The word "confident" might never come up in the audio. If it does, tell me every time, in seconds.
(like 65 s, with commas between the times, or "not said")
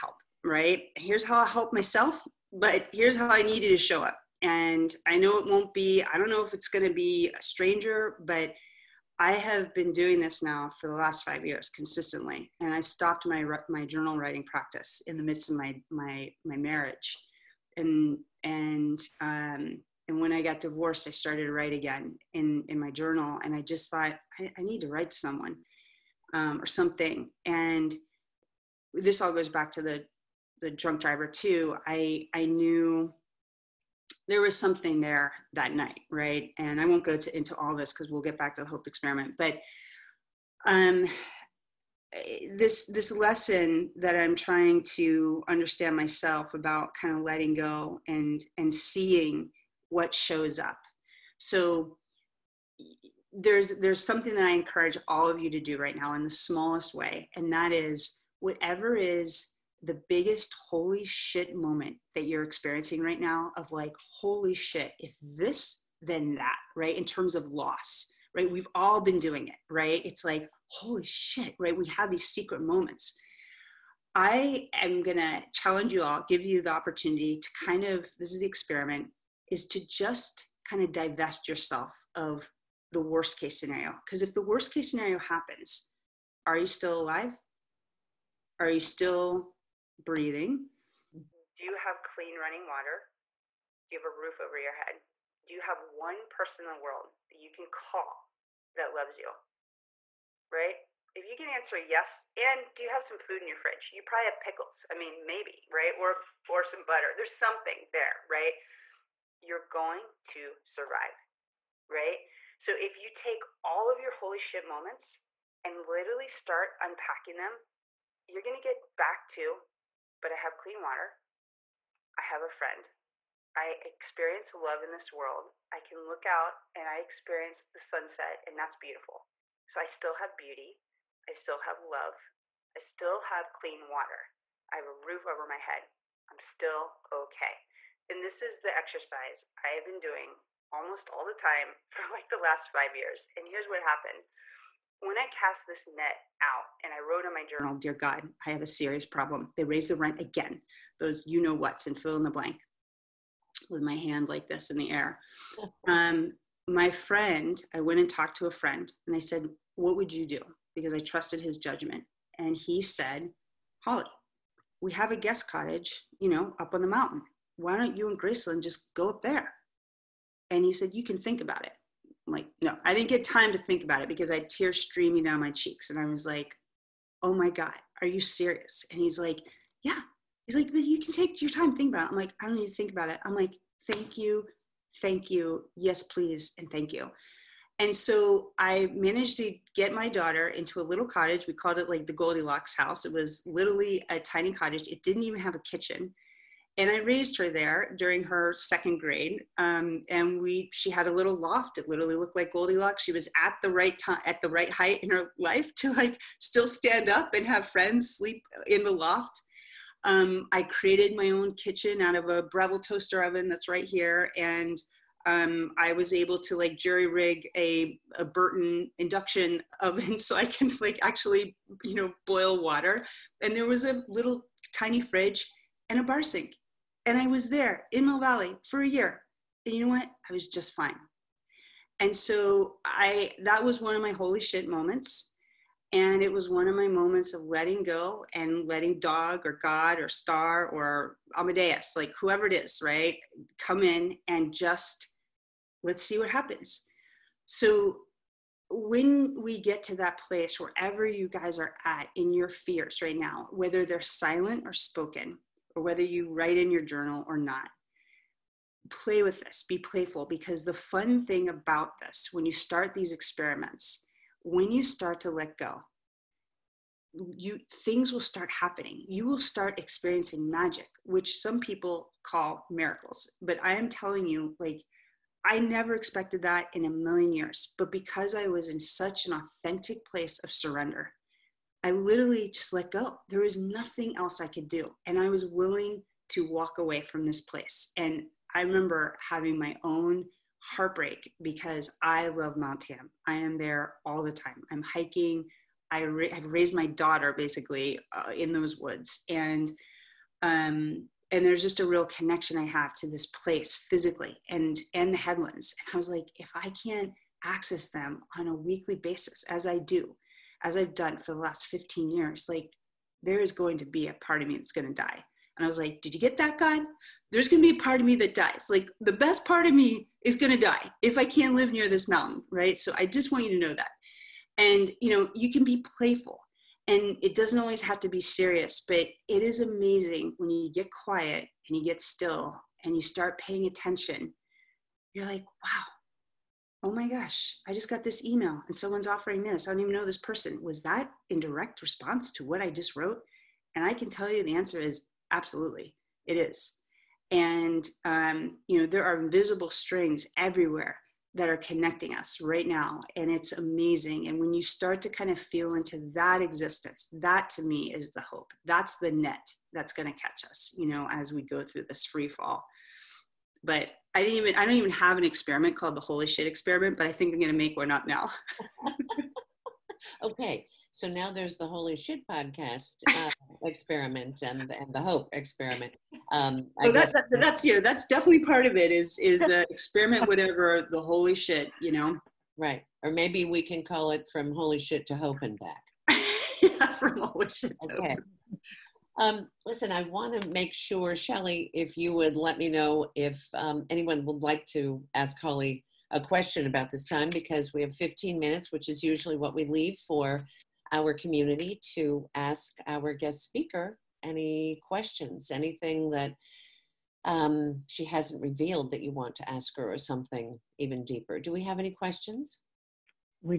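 not said.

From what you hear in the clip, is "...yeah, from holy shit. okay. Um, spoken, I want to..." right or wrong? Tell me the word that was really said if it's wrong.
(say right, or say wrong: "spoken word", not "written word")
wrong: "listen", not "spoken".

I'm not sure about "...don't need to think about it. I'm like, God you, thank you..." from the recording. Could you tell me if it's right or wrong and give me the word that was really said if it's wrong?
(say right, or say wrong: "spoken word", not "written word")
wrong: "Thank", not "God".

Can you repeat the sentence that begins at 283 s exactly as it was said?
There was nothing else I could do.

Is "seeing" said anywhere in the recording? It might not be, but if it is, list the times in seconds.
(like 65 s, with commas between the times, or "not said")
48 s.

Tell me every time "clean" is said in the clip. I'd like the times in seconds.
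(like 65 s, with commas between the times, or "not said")
92 s, 120 s, 133 s.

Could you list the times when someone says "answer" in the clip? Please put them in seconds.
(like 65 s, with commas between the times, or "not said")
101 s, 344 s.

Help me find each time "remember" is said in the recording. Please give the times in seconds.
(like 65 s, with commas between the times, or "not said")
288 s.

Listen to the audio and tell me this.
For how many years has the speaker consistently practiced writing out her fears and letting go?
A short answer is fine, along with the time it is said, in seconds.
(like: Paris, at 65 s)
5 years, at 10 s.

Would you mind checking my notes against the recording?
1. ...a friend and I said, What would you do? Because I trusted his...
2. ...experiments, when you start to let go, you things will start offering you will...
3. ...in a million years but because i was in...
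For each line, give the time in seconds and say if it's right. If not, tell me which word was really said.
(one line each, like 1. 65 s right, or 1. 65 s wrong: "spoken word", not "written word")
1. 158 s right
2. 263 s wrong: "happening", not "offering"
3. 276 s right.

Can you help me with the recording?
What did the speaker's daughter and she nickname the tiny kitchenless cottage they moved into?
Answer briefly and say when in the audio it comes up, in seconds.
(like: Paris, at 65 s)
the Goldilocks house, at 192 s.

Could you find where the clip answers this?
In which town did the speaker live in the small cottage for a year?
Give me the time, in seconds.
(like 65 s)
228 s.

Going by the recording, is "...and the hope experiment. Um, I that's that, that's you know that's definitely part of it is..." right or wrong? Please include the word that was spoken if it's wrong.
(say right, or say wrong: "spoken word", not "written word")
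right.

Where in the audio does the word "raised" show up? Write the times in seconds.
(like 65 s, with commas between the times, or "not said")
149 s, 196 s, 296 s.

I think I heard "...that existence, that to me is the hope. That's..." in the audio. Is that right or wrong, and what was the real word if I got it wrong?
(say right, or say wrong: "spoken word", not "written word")
right.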